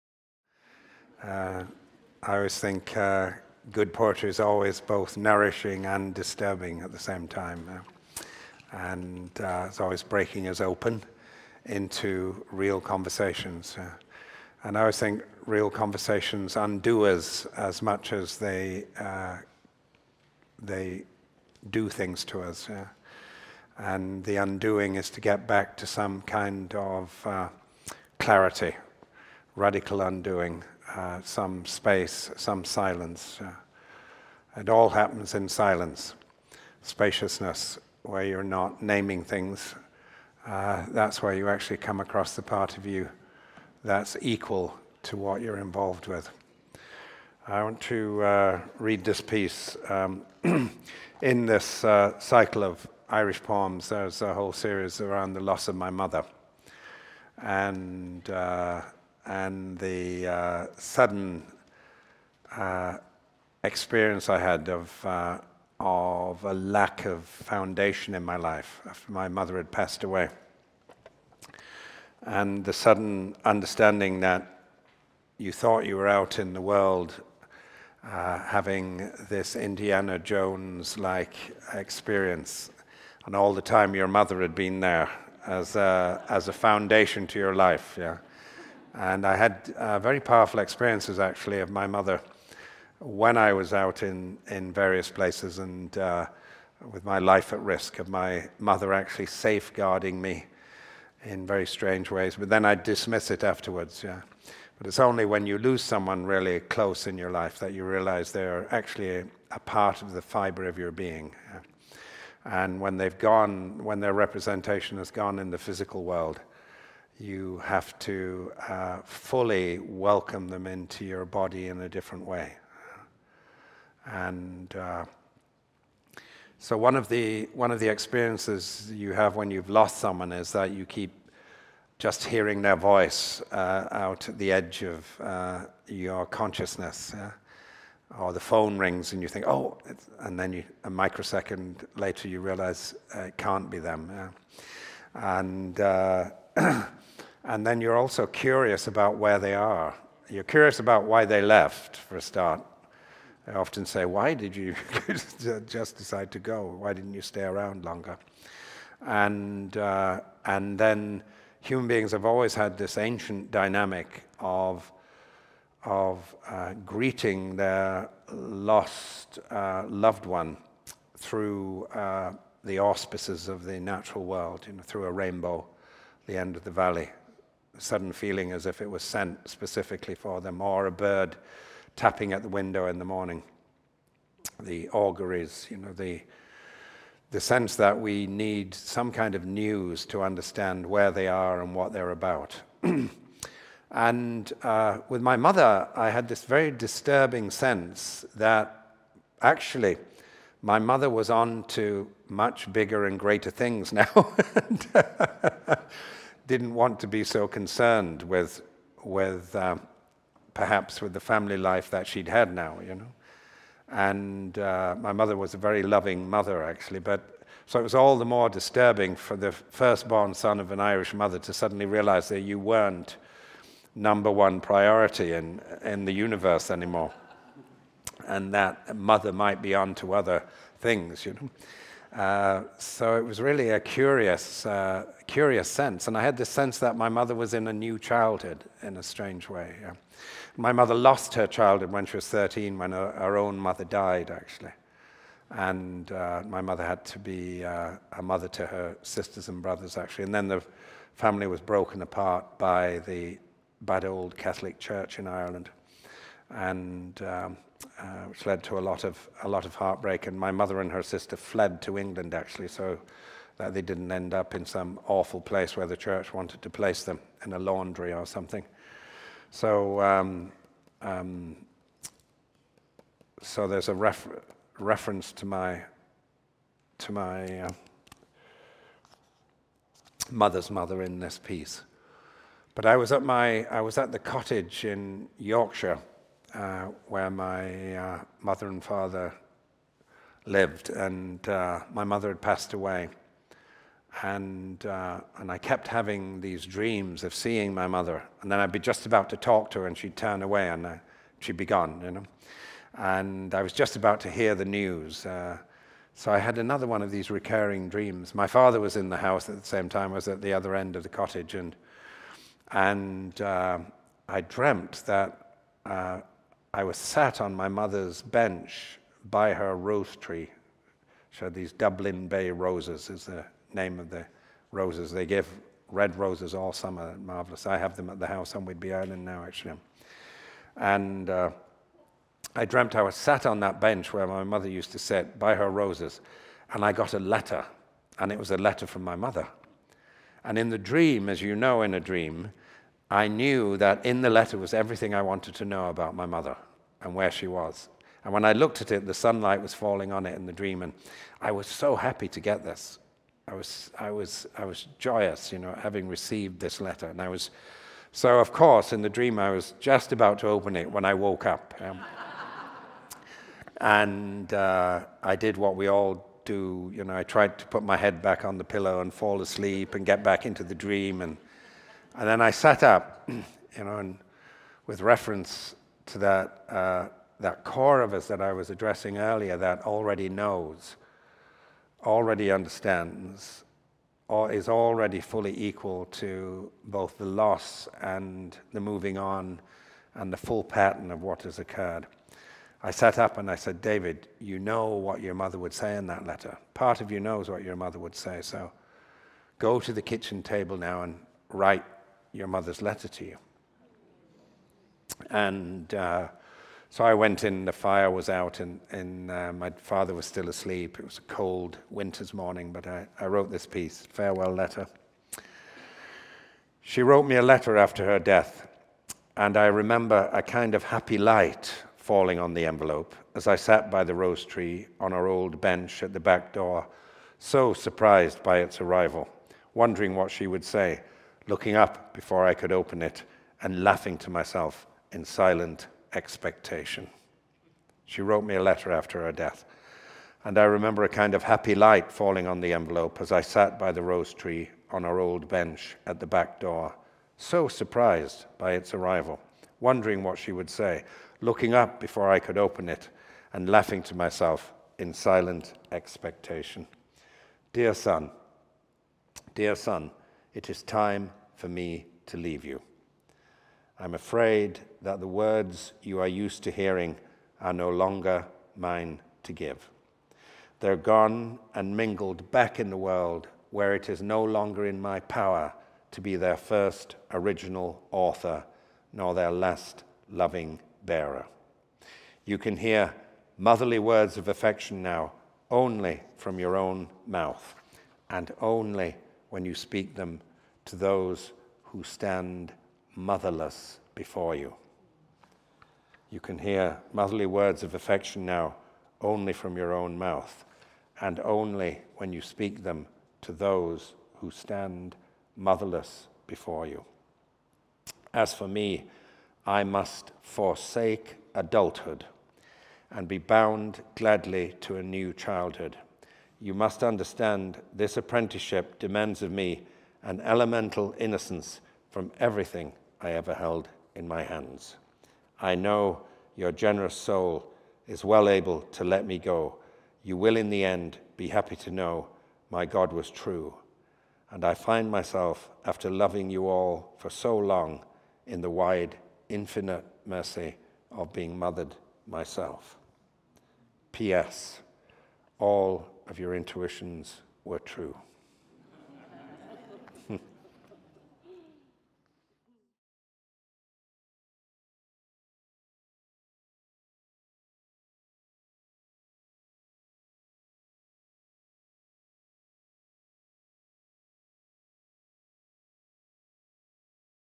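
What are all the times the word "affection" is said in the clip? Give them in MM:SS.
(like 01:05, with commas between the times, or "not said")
08:04, 08:17.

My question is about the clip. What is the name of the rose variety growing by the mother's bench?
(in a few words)
Dublin Bay roses.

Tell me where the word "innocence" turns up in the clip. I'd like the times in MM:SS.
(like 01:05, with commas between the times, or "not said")
08:41.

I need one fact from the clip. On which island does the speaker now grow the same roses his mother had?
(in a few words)
Whidbey Island.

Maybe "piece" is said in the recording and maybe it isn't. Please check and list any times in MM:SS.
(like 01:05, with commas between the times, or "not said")
00:49, 04:41, 06:53.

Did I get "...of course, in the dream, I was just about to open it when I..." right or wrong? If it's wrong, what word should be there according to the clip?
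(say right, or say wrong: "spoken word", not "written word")
right.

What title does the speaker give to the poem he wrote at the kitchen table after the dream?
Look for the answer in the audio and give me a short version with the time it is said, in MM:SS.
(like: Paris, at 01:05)
Farewell Letter, at 06:54.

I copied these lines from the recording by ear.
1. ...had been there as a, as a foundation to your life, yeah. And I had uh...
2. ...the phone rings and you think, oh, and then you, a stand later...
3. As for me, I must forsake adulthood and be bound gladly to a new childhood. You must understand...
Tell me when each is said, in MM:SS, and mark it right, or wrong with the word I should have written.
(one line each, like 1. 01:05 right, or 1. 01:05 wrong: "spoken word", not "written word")
1. 01:24 right
2. 02:18 wrong: "microsecond", not "stand"
3. 08:28 right.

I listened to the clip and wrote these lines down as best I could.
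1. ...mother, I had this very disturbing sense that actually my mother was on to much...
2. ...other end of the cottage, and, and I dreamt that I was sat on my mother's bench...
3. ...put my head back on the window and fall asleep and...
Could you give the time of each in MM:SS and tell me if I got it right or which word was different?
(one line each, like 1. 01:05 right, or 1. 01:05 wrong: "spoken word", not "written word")
1. 03:15 right
2. 05:10 right
3. 06:07 wrong: "pillow", not "window".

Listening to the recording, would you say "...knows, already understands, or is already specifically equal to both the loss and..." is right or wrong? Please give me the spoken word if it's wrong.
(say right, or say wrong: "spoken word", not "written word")
wrong: "fully", not "specifically".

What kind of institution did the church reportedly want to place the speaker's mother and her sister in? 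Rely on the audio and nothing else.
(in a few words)
a laundry.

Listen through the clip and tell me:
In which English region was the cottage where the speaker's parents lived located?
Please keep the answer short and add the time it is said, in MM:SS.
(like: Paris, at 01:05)
Yorkshire, at 04:45.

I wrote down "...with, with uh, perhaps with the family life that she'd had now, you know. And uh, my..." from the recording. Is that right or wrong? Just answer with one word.
right.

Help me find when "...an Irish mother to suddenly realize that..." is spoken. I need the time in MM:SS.
03:40.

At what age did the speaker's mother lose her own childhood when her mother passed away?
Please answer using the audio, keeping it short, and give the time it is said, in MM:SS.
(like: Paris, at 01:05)
13, at 04:02.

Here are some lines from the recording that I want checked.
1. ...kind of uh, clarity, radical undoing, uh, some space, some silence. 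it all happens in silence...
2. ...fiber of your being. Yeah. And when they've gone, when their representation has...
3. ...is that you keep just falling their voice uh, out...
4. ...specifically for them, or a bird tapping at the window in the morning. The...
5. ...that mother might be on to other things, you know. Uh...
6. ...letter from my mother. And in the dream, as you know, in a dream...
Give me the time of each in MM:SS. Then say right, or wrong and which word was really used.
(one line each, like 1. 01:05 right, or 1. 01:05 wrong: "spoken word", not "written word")
1. 00:26 right
2. 01:50 right
3. 02:10 wrong: "hearing", not "falling"
4. 02:59 right
5. 03:48 right
6. 05:38 right.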